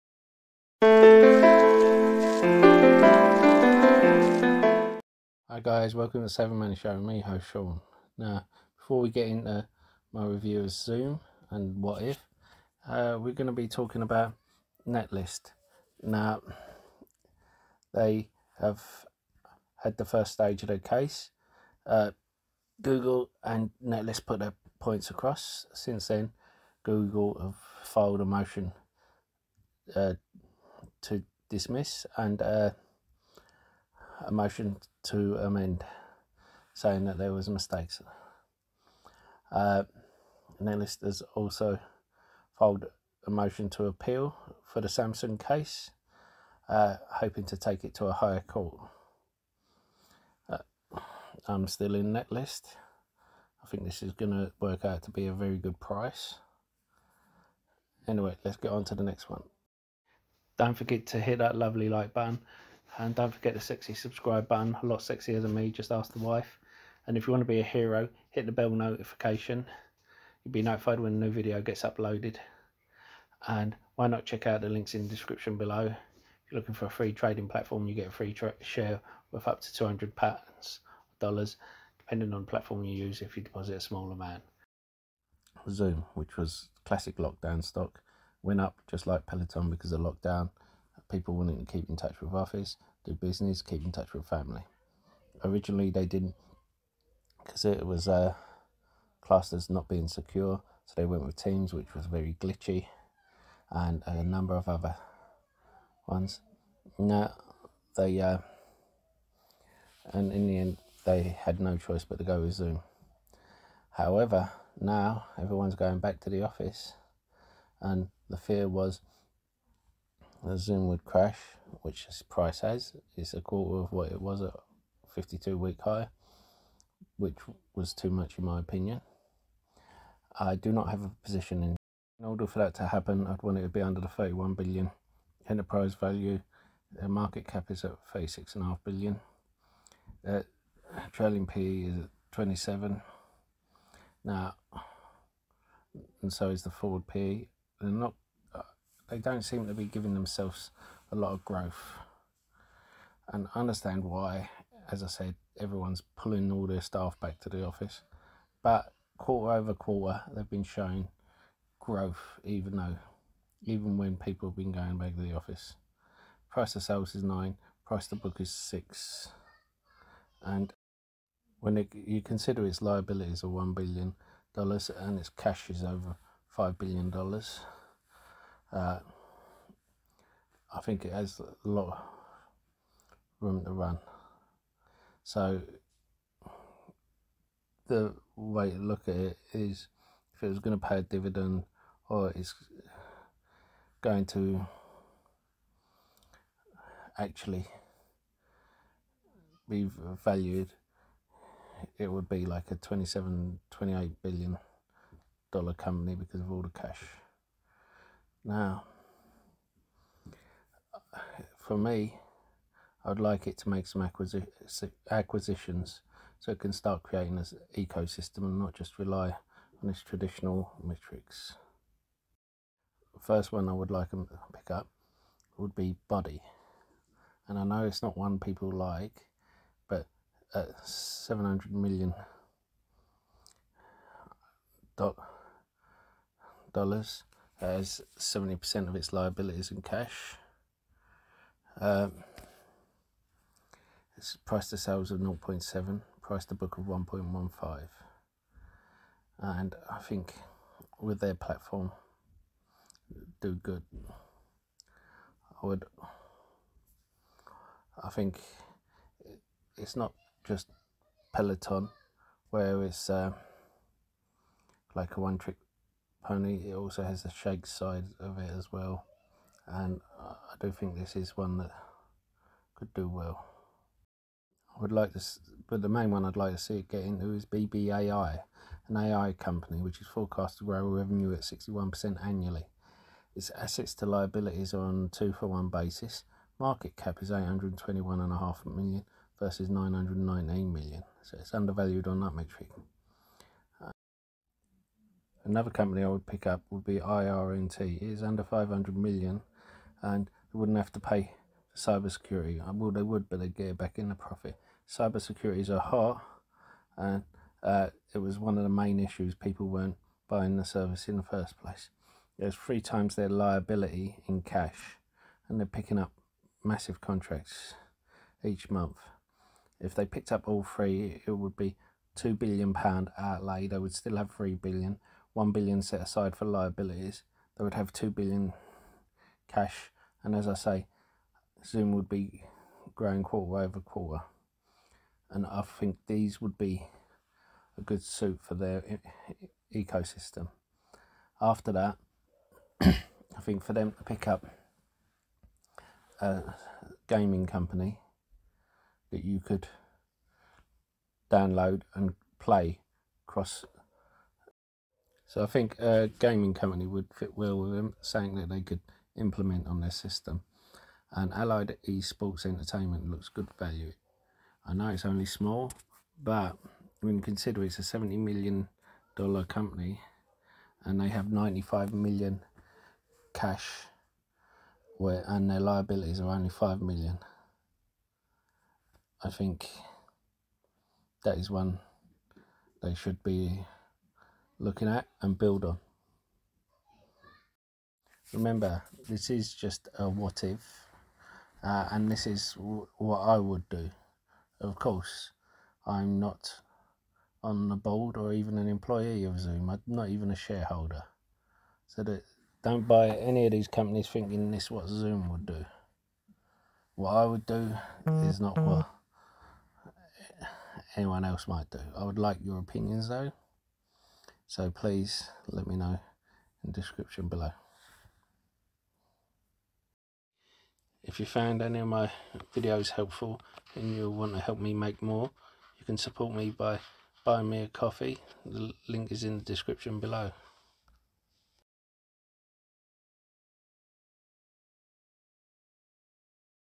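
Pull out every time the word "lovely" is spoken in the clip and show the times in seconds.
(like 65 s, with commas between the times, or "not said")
61 s.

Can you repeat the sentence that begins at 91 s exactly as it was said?
People wanting to keep in touch with office, do business, keep in touch with family.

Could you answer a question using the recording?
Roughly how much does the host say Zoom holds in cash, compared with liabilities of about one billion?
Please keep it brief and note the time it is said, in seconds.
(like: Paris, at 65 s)
over 5 billion dollars, at 175 s.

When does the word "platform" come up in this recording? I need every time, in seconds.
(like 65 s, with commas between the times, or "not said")
77 s, 82 s, 251 s.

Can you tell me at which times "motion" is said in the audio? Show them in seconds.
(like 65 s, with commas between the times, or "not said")
28 s, 34 s, 43 s.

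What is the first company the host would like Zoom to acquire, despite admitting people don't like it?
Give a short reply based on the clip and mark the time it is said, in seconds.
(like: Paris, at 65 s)
Buddy, at 226 s.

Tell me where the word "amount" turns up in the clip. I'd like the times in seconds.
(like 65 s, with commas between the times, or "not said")
84 s.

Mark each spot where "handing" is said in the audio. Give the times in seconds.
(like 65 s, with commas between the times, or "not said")
not said.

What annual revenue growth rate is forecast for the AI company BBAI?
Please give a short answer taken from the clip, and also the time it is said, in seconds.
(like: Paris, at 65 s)
61%, at 281 s.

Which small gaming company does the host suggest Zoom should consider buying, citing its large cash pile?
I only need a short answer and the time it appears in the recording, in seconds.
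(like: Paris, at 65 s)
Allied Esports Entertainment, at 361 s.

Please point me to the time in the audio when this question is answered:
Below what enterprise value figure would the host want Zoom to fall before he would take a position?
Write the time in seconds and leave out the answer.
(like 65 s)
134 s.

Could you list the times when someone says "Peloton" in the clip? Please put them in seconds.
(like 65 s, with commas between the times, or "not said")
89 s, 261 s.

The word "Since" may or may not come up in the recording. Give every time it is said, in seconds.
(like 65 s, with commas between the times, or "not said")
25 s.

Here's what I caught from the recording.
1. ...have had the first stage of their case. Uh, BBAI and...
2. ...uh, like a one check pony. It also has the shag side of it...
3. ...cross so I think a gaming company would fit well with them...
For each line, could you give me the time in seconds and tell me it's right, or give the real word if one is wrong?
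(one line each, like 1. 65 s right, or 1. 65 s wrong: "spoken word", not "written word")
1. 18 s wrong: "Google", not "BBAI"
2. 263 s wrong: "trick", not "check"
3. 353 s right.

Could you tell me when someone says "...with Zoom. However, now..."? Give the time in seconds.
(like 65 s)
112 s.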